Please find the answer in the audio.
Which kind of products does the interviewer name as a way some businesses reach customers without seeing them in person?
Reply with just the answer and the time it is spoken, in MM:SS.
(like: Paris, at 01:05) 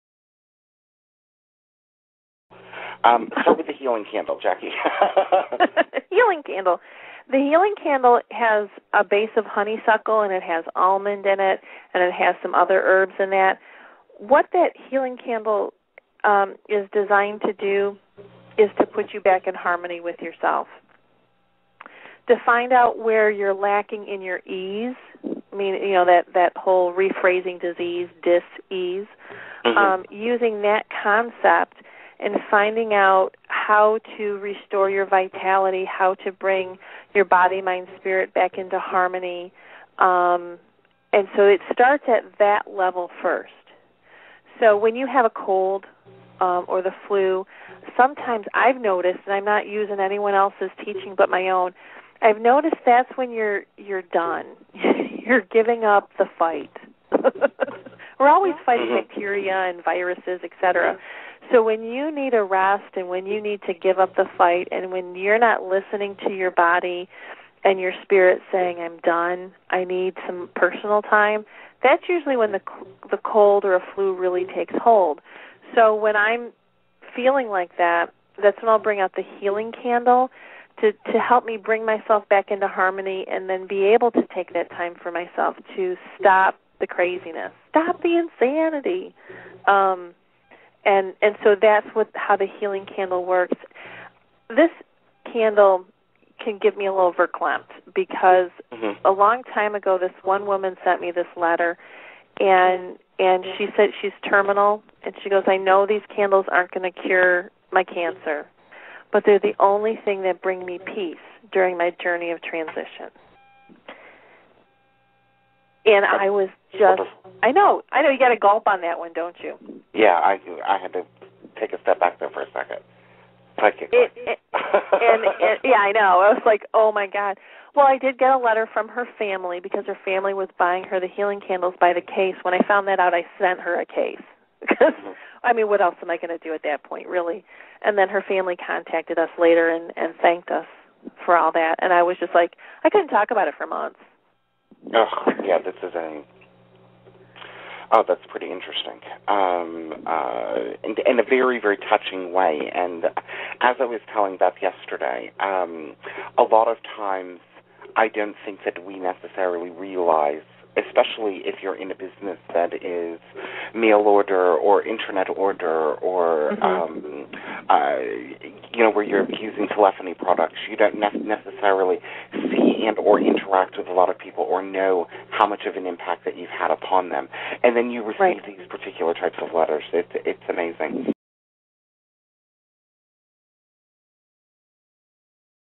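Telephony products, at 02:49.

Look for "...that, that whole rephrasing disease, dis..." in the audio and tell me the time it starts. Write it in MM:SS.
00:26.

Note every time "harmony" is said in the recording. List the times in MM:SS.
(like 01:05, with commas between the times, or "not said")
00:19, 00:38, 01:22.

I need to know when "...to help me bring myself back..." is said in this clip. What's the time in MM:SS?
01:21.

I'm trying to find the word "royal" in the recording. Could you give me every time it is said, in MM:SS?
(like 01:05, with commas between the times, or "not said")
not said.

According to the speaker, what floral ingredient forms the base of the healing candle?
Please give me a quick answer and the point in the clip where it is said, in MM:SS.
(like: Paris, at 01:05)
Honeysuckle, at 00:09.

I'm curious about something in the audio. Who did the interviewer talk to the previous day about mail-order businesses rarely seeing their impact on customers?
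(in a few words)
Beth.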